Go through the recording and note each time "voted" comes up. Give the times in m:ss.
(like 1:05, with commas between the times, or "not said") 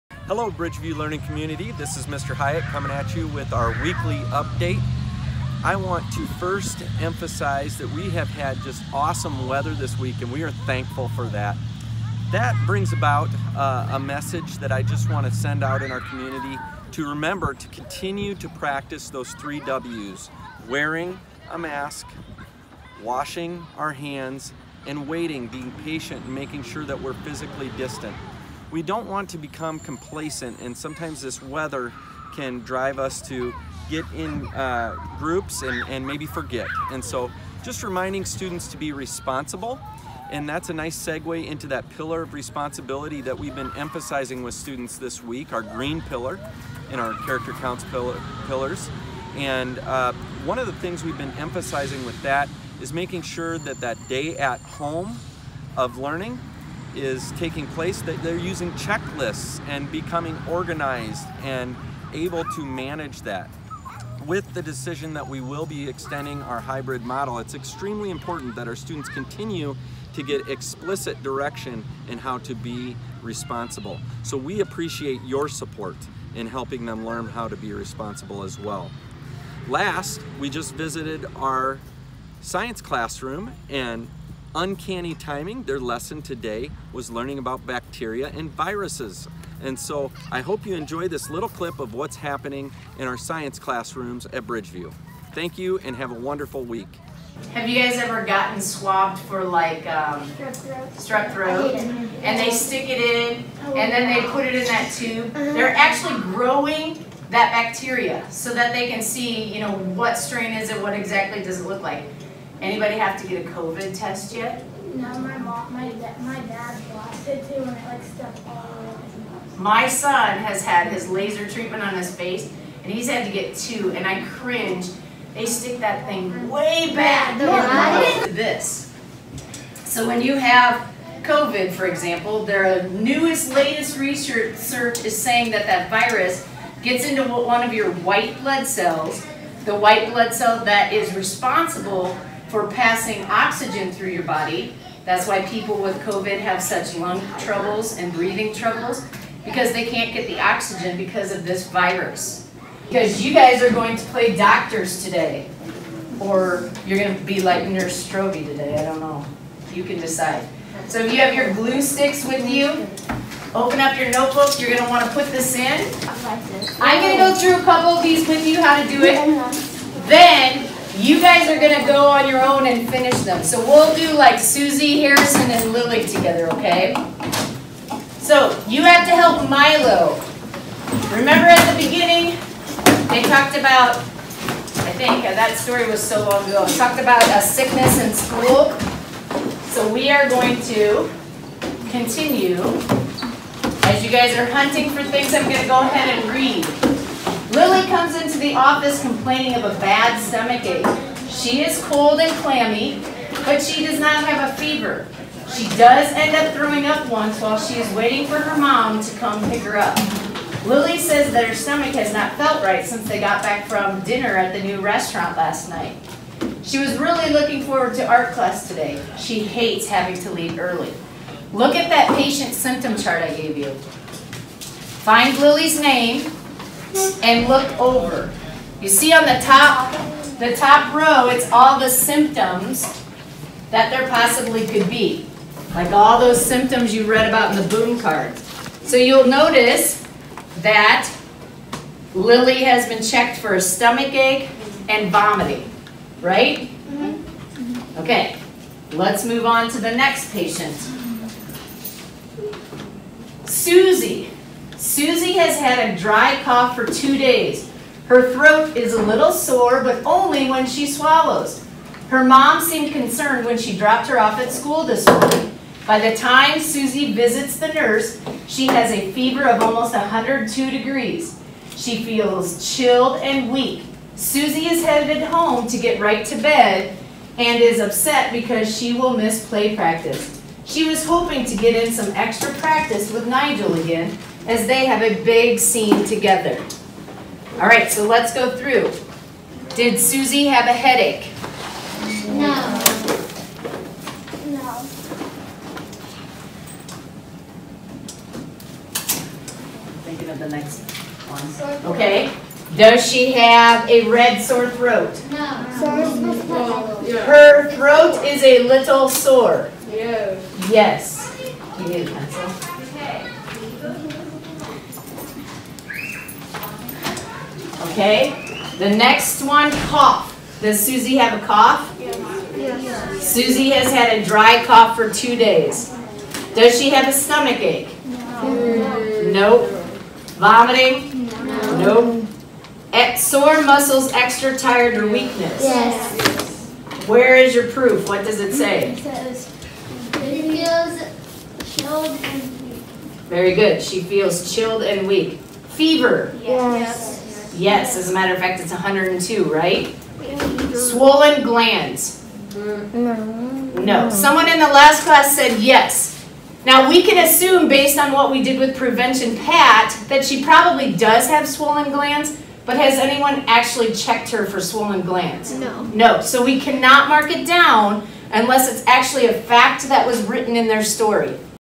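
not said.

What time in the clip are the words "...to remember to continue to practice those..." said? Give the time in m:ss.
0:16.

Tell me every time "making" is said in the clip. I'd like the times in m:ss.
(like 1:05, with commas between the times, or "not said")
0:26, 0:52.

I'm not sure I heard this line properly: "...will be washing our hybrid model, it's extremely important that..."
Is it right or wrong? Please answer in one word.
wrong.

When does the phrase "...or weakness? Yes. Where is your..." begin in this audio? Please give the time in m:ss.
5:34.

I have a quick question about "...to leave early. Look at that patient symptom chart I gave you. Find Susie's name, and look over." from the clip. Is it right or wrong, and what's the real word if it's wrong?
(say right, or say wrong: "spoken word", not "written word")
wrong: "Lily", not "Susie".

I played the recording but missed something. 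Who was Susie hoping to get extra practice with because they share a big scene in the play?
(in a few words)
Nigel.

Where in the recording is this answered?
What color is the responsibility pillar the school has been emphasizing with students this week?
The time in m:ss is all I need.
0:45.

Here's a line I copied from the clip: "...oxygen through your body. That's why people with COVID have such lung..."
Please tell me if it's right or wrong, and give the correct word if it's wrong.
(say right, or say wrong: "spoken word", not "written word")
right.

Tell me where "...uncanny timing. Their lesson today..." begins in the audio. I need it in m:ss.
1:24.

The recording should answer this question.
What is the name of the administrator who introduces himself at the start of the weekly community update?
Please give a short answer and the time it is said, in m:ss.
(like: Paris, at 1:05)
Mr. 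Hyatt, at 0:02.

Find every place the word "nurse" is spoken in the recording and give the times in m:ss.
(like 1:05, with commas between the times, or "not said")
2:37, 4:27.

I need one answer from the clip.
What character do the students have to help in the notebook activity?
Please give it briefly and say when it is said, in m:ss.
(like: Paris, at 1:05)
Milo, at 2:59.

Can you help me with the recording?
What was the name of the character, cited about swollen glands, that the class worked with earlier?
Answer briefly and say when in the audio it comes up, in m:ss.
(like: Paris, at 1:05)
Prevention Pat, at 5:58.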